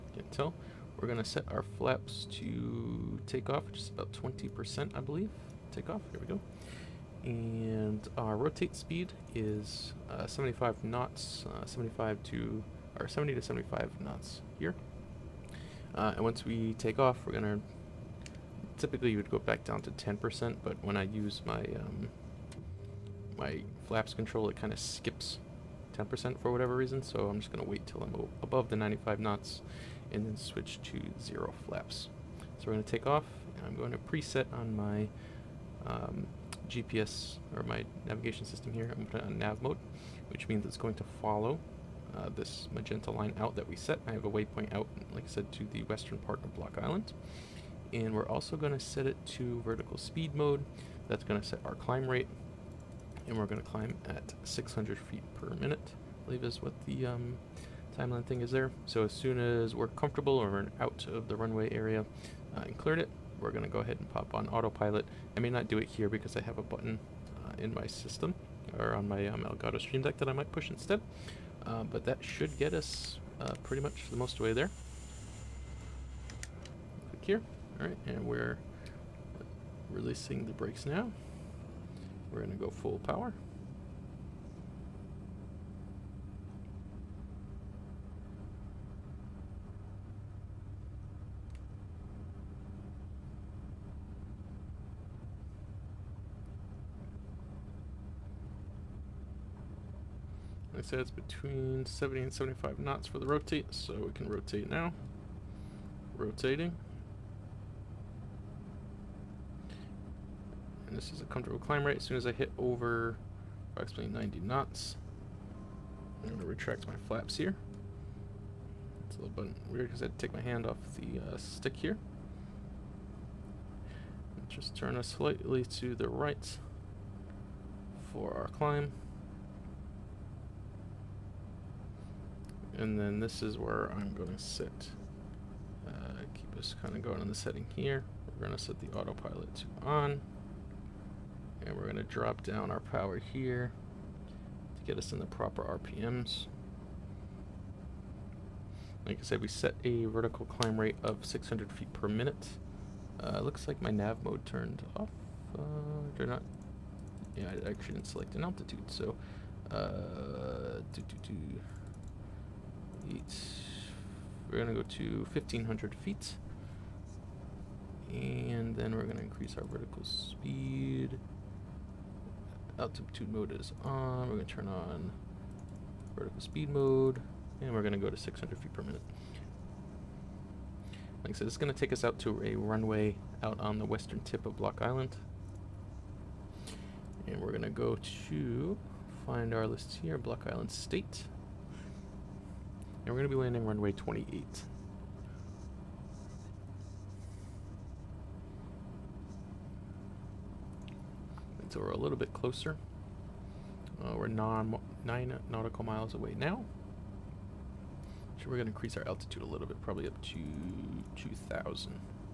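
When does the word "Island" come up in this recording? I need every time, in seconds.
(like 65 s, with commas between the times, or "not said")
46 s, 184 s, 190 s.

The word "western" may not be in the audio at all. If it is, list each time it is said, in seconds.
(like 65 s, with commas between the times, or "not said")
45 s, 183 s.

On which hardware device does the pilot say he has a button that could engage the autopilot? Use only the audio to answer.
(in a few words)
Elgato Stream Deck.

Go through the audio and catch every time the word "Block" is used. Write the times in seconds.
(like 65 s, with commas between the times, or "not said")
46 s, 184 s, 190 s.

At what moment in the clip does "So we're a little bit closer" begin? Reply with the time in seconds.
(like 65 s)
201 s.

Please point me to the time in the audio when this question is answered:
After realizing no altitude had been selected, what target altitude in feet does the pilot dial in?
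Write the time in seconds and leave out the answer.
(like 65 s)
165 s.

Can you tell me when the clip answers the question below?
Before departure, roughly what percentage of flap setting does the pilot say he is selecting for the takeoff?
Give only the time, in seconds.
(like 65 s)
4 s.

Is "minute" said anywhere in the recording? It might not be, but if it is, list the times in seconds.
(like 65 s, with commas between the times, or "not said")
55 s, 152 s, 178 s.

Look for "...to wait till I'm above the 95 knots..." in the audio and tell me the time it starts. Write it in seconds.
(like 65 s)
27 s.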